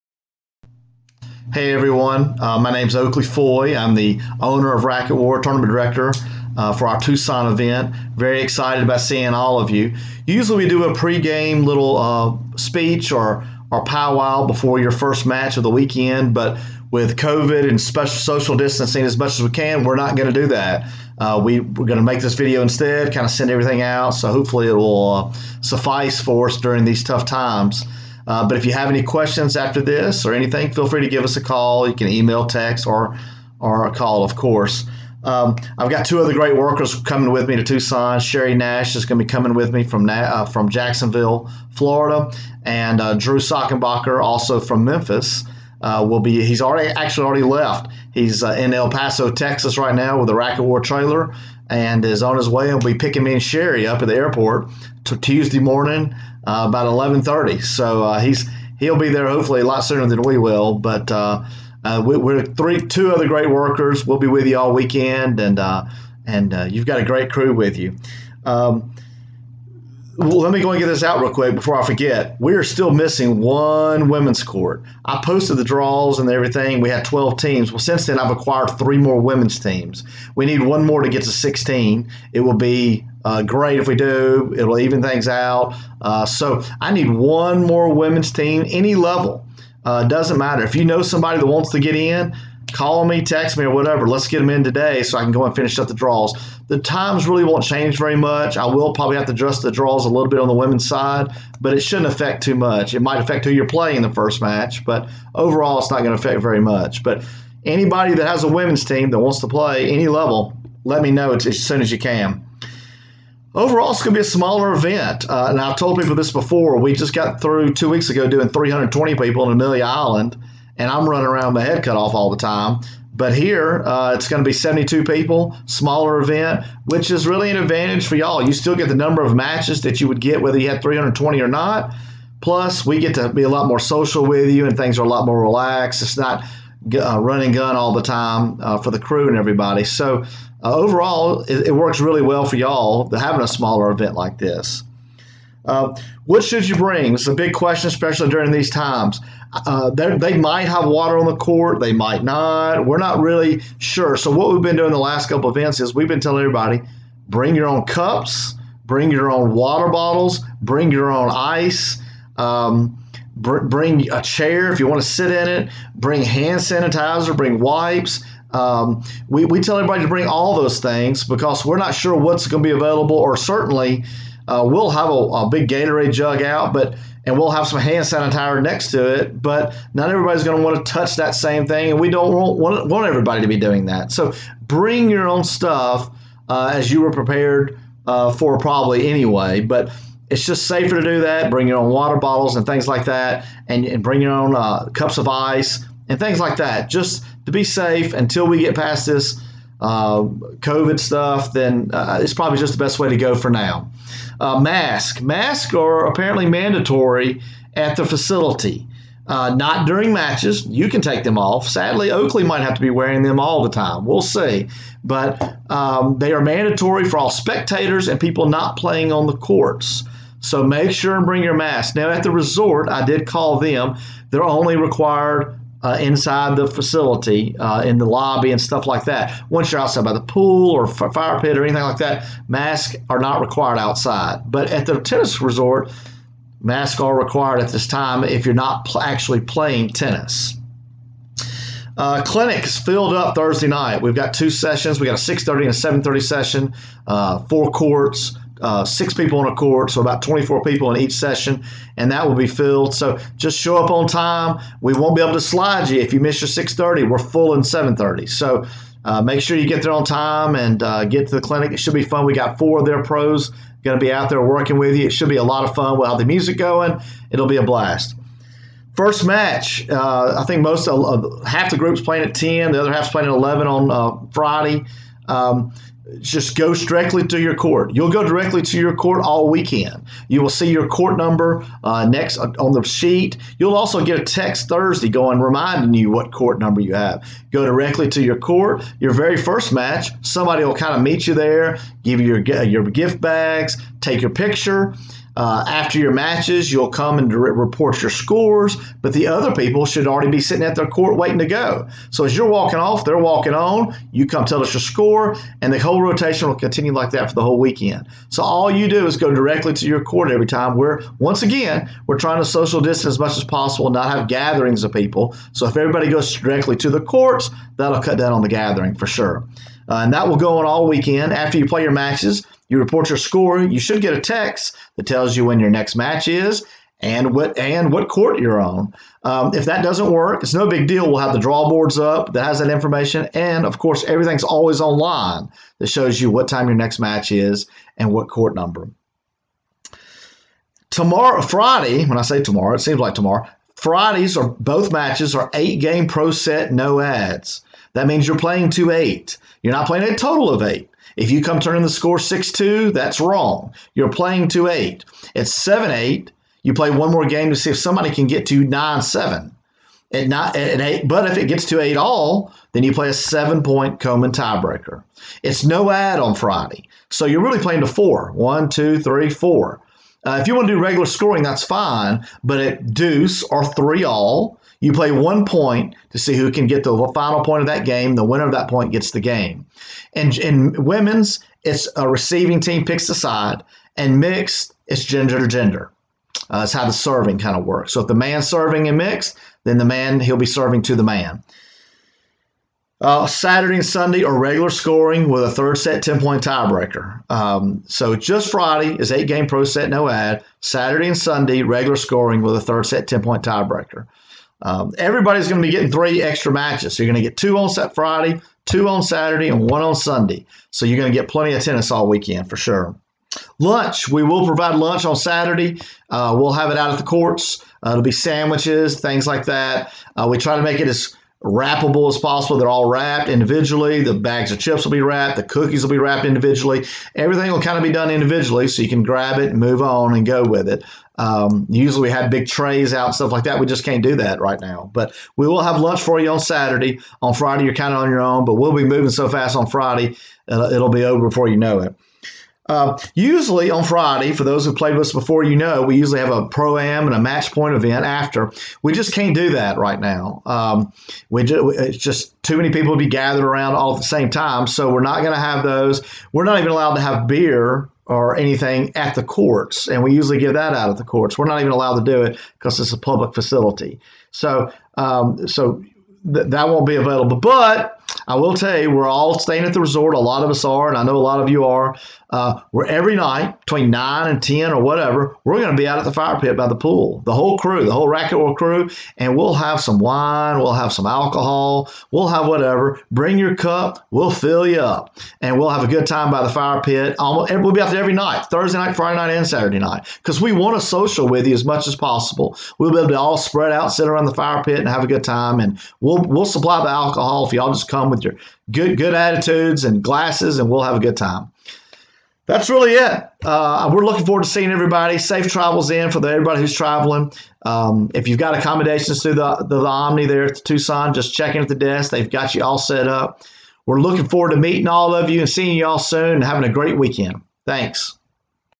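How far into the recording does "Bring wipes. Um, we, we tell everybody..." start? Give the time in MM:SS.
02:47.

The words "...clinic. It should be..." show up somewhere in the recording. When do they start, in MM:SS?
04:21.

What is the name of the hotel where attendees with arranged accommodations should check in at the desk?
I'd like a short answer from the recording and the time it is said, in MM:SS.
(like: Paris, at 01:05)
Omni, at 08:29.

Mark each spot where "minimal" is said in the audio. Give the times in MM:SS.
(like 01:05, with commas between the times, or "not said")
not said.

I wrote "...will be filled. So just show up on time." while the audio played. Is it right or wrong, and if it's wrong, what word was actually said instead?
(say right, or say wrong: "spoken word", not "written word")
right.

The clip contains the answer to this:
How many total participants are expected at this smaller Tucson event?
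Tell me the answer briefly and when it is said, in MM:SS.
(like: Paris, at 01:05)
72, at 02:04.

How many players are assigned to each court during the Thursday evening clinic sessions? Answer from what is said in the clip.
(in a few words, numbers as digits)
6.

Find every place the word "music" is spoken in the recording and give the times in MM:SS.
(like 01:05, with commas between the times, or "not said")
04:26.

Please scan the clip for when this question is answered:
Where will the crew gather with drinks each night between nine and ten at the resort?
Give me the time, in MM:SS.
07:56.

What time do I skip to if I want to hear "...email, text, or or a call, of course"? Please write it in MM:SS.
00:32.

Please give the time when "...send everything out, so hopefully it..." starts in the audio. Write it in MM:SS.
00:23.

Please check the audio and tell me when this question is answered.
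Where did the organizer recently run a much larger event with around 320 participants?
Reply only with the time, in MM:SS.
01:59.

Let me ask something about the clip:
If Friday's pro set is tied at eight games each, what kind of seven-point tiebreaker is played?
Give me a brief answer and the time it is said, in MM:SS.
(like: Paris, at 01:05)
Coman tiebreaker, at 06:04.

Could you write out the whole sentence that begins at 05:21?
After you play your matches you report your score.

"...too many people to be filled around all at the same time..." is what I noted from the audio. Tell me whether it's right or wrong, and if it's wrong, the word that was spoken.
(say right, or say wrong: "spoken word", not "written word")
wrong: "gathered", not "filled".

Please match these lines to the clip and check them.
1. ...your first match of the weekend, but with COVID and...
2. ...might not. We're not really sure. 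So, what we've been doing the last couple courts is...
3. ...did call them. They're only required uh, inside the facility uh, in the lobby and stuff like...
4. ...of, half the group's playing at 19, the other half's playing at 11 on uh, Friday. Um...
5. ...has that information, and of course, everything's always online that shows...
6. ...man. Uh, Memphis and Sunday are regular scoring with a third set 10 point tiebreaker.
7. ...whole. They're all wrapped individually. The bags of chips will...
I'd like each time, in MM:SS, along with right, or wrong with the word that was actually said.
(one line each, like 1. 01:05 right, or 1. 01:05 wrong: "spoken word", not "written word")
1. 00:14 right
2. 02:31 wrong: "events", not "courts"
3. 03:43 right
4. 04:30 wrong: "10", not "19"
5. 05:32 right
6. 06:31 wrong: "Saturday", not "Memphis"
7. 07:02 wrong: "possible", not "whole".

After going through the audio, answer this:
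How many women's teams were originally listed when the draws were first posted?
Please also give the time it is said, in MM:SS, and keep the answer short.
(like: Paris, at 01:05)
12, at 01:17.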